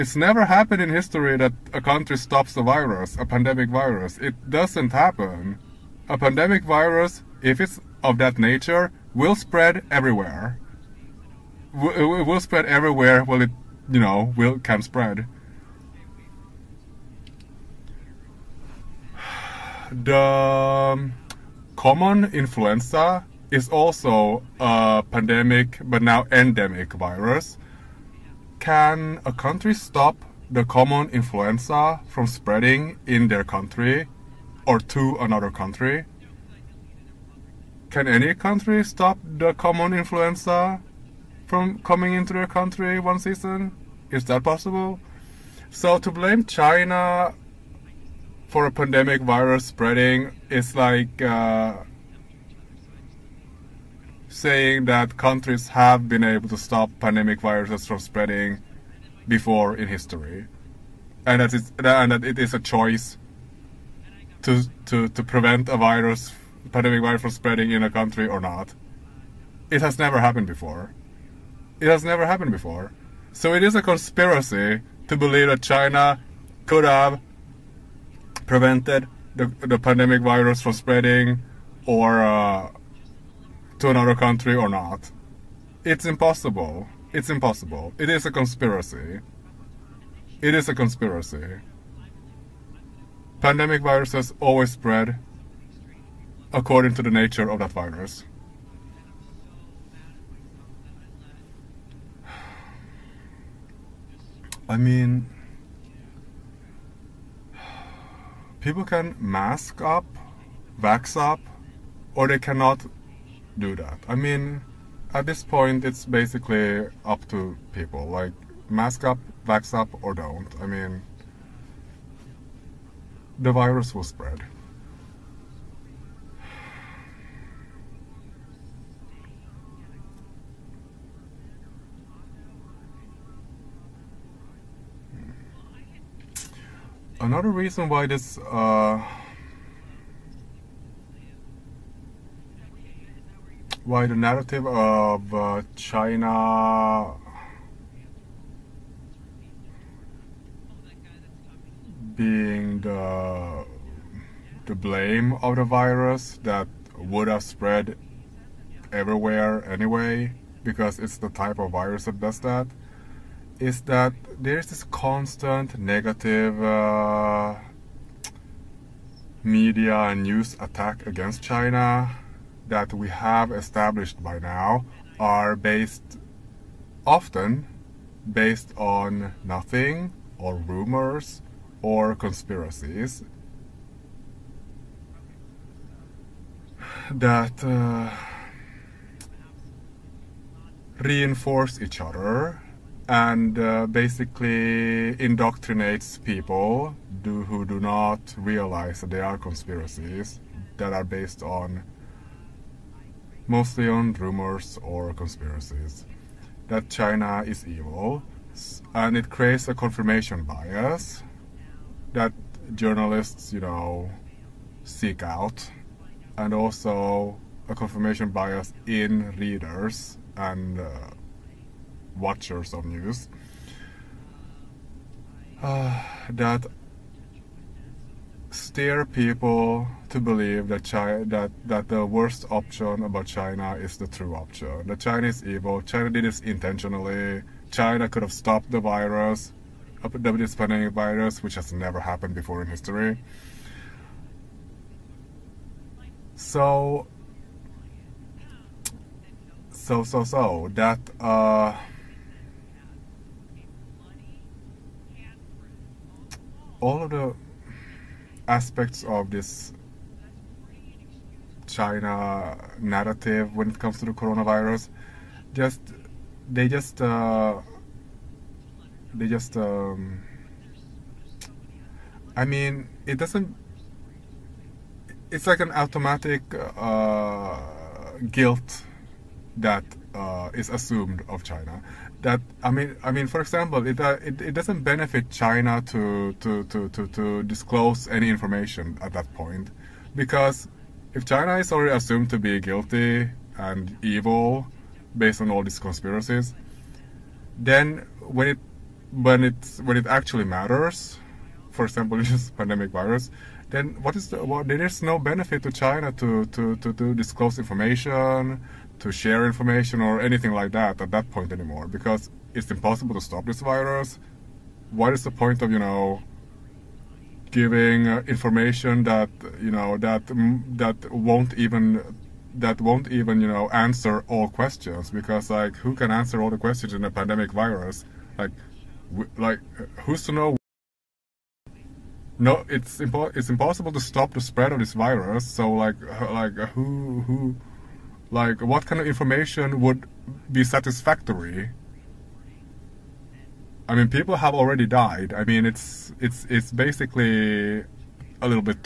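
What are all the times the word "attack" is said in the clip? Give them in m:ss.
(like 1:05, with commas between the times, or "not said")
2:50.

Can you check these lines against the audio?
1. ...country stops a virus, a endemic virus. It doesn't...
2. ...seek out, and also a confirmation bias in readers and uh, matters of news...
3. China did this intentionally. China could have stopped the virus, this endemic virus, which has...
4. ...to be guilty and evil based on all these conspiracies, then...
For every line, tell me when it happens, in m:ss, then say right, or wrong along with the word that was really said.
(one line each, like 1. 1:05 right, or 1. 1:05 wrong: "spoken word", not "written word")
1. 0:01 wrong: "pandemic", not "endemic"
2. 3:34 wrong: "watchers", not "matters"
3. 3:55 wrong: "pandemic", not "endemic"
4. 4:52 right.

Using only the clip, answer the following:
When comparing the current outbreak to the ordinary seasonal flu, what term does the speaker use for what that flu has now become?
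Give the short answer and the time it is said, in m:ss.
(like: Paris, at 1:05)
endemic, at 0:26.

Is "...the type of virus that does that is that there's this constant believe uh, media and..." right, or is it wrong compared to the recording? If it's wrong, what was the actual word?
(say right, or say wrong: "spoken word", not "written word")
wrong: "negative", not "believe".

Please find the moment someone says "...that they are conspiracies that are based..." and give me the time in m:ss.
3:18.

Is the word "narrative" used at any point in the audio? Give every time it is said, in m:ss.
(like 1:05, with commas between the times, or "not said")
2:24, 4:22.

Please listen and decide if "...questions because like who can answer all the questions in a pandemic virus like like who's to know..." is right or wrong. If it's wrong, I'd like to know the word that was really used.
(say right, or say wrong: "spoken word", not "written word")
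right.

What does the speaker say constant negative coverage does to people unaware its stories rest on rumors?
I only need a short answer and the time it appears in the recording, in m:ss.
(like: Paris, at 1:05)
indoctrinates, at 3:15.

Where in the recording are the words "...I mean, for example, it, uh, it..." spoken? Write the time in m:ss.
4:43.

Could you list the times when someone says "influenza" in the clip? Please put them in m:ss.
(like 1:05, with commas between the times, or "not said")
0:22, 0:31, 0:39.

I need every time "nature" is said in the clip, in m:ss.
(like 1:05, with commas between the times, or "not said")
0:08, 1:37.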